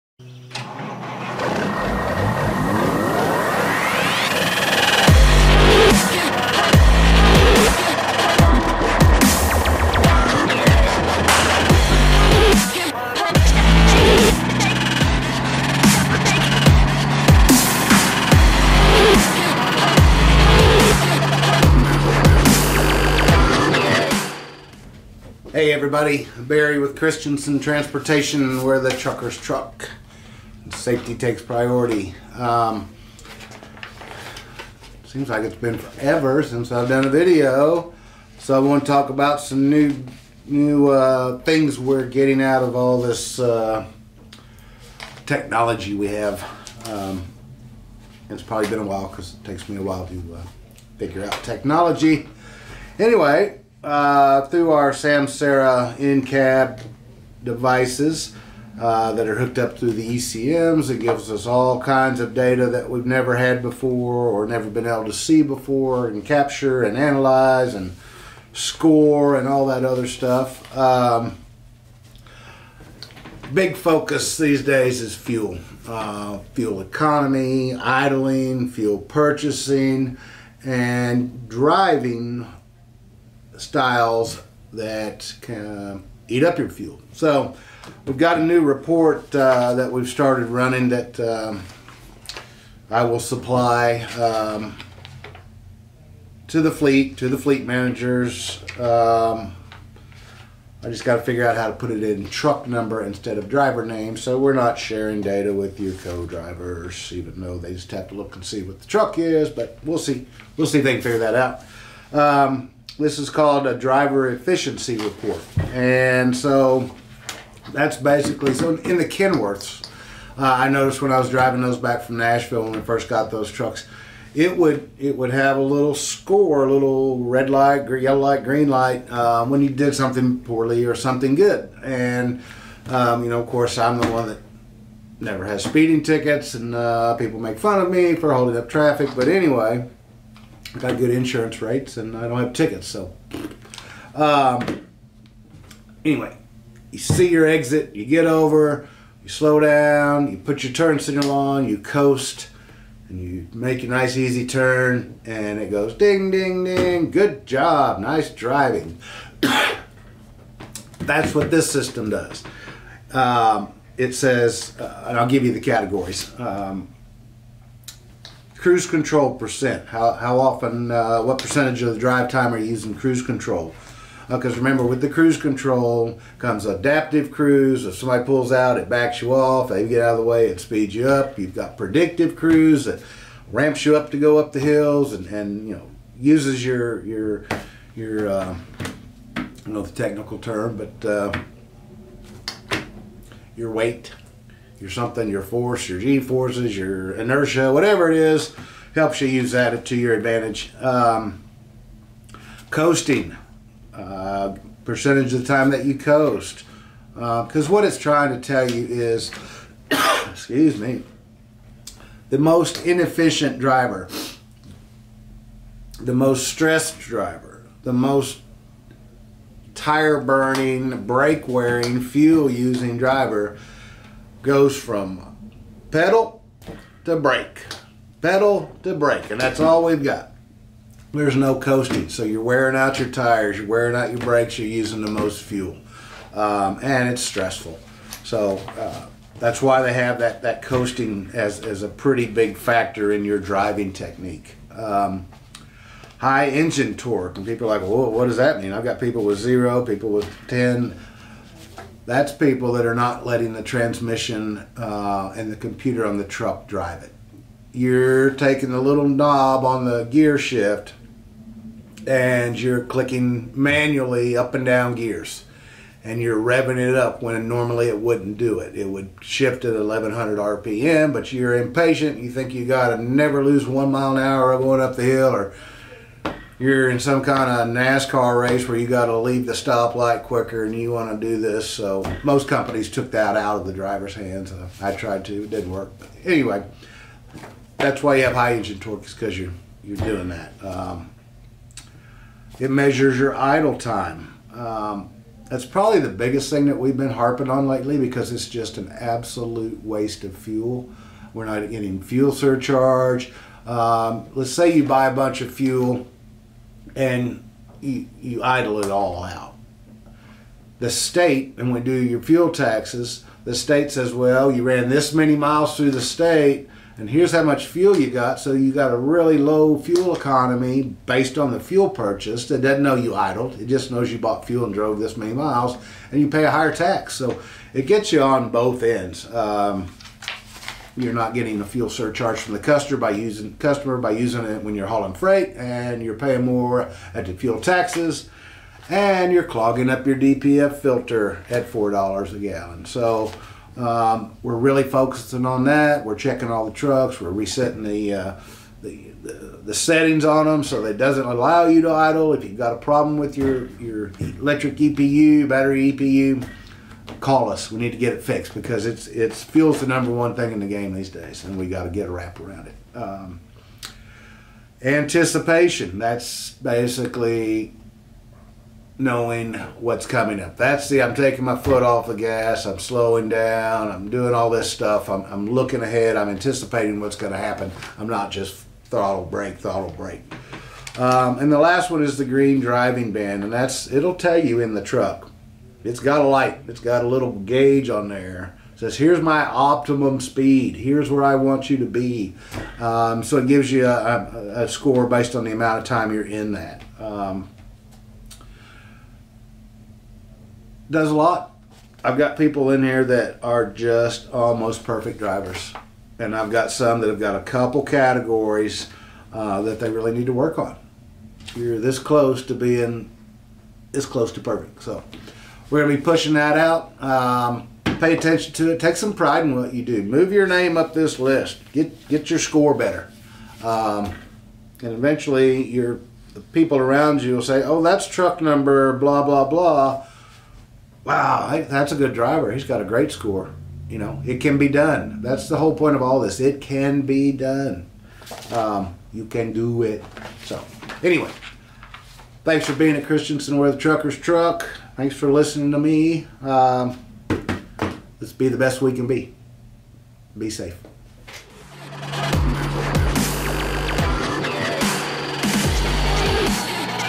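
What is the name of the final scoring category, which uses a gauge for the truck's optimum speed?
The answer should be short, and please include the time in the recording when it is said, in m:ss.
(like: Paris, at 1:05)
Green driving band, at 6:22.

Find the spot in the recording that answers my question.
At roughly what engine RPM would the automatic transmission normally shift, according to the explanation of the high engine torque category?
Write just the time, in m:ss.
4:29.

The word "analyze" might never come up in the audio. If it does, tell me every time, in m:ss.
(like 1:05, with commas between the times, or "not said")
1:06.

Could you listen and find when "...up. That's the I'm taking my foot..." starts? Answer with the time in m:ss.
6:10.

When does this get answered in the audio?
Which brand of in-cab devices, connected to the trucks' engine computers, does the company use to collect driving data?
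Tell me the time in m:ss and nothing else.
0:54.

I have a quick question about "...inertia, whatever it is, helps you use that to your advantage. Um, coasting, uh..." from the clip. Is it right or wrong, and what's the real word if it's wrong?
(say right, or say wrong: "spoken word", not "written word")
right.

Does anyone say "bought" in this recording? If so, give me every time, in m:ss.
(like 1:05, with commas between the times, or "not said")
5:24.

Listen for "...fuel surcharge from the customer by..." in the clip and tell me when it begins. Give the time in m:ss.
5:31.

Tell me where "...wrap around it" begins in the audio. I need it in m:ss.
6:02.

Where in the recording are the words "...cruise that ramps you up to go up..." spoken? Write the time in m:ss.
3:02.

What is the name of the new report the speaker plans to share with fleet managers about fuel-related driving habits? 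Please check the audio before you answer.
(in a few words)
Driver efficiency report.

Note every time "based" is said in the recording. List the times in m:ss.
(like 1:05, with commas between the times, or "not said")
5:21, 6:35.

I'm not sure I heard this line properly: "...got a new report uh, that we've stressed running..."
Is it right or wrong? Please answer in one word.
wrong.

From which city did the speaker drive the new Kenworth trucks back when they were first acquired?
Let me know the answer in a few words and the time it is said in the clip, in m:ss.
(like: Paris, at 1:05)
Nashville, at 2:02.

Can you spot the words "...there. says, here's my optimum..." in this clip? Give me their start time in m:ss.
6:28.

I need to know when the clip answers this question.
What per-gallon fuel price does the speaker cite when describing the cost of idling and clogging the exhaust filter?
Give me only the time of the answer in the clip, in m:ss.
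5:41.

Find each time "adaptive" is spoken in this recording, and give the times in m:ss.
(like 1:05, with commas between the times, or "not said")
2:56.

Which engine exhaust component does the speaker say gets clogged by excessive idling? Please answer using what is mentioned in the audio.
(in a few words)
DPF filter.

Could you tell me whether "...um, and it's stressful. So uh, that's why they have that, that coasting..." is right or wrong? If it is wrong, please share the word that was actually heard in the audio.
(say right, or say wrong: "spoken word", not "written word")
right.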